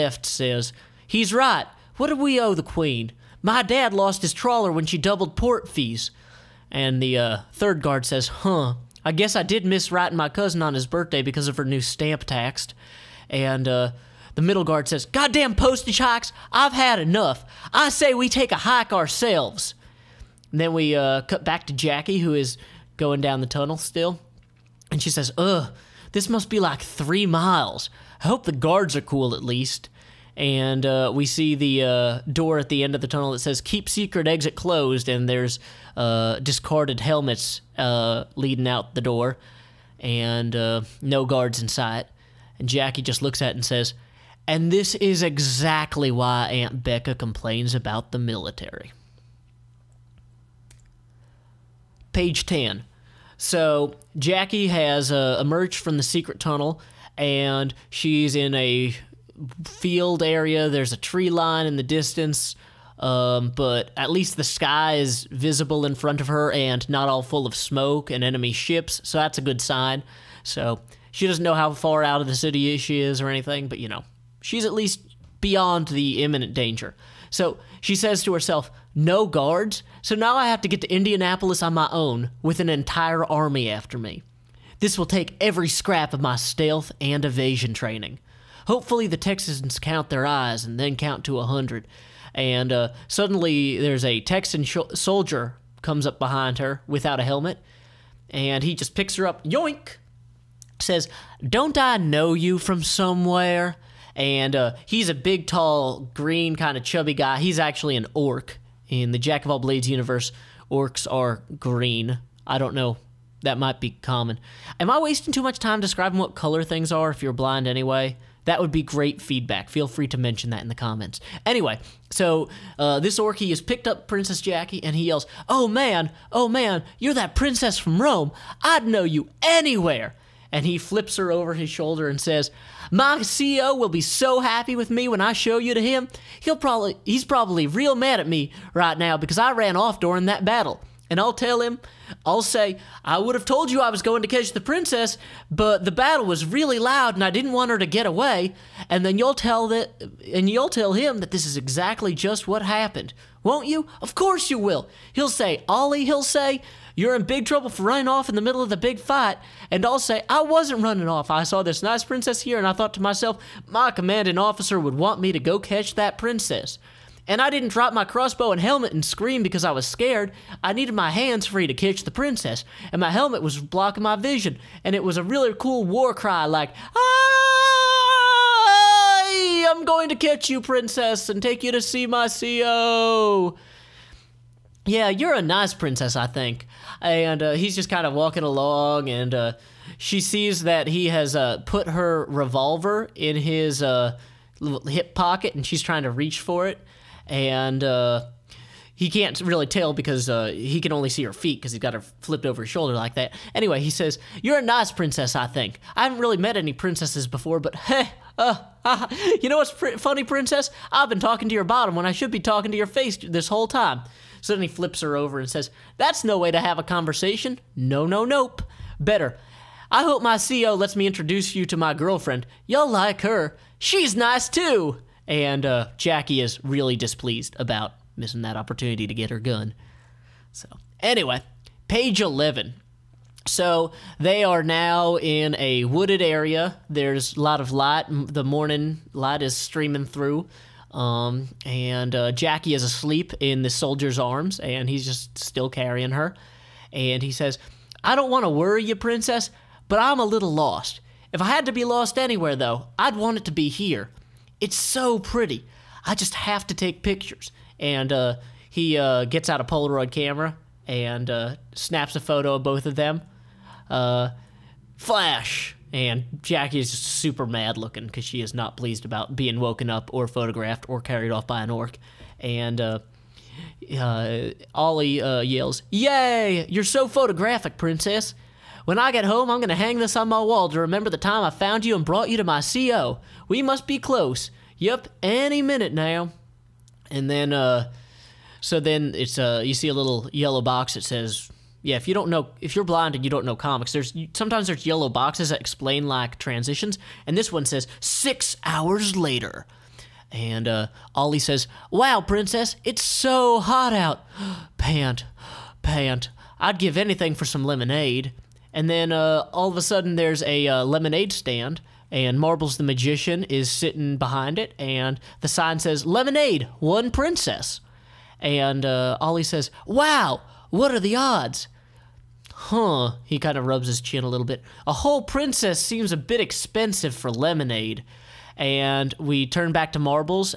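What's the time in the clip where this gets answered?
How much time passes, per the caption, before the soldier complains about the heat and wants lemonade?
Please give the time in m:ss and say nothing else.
4:57.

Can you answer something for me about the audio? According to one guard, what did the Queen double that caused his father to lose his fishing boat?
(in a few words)
port fees.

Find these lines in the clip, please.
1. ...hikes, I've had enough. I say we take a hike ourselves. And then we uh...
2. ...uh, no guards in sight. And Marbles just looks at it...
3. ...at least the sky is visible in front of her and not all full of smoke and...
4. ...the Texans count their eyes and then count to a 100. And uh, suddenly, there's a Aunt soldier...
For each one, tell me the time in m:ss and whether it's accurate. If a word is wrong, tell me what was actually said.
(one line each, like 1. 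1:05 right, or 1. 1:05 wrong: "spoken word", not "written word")
1. 0:15 right
2. 0:40 wrong: "Jacqi", not "Marbles"
3. 1:03 right
4. 1:29 wrong: "Texan", not "Aunt".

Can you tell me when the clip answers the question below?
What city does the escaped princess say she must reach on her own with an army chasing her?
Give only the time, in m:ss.
1:20.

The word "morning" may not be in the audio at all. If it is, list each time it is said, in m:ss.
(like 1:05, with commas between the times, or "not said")
3:58.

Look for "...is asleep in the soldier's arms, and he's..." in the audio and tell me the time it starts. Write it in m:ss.
4:02.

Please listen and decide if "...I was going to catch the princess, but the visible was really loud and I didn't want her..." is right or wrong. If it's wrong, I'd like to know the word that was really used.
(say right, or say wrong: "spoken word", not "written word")
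wrong: "battle", not "visible".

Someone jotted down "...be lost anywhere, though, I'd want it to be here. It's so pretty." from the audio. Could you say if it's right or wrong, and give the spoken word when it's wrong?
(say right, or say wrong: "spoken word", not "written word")
right.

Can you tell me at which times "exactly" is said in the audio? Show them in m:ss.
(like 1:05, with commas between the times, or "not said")
0:45, 2:31.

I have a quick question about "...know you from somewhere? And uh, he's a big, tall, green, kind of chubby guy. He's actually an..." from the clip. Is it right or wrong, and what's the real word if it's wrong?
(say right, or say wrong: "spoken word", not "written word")
right.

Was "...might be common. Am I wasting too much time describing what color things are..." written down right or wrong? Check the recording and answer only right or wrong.
right.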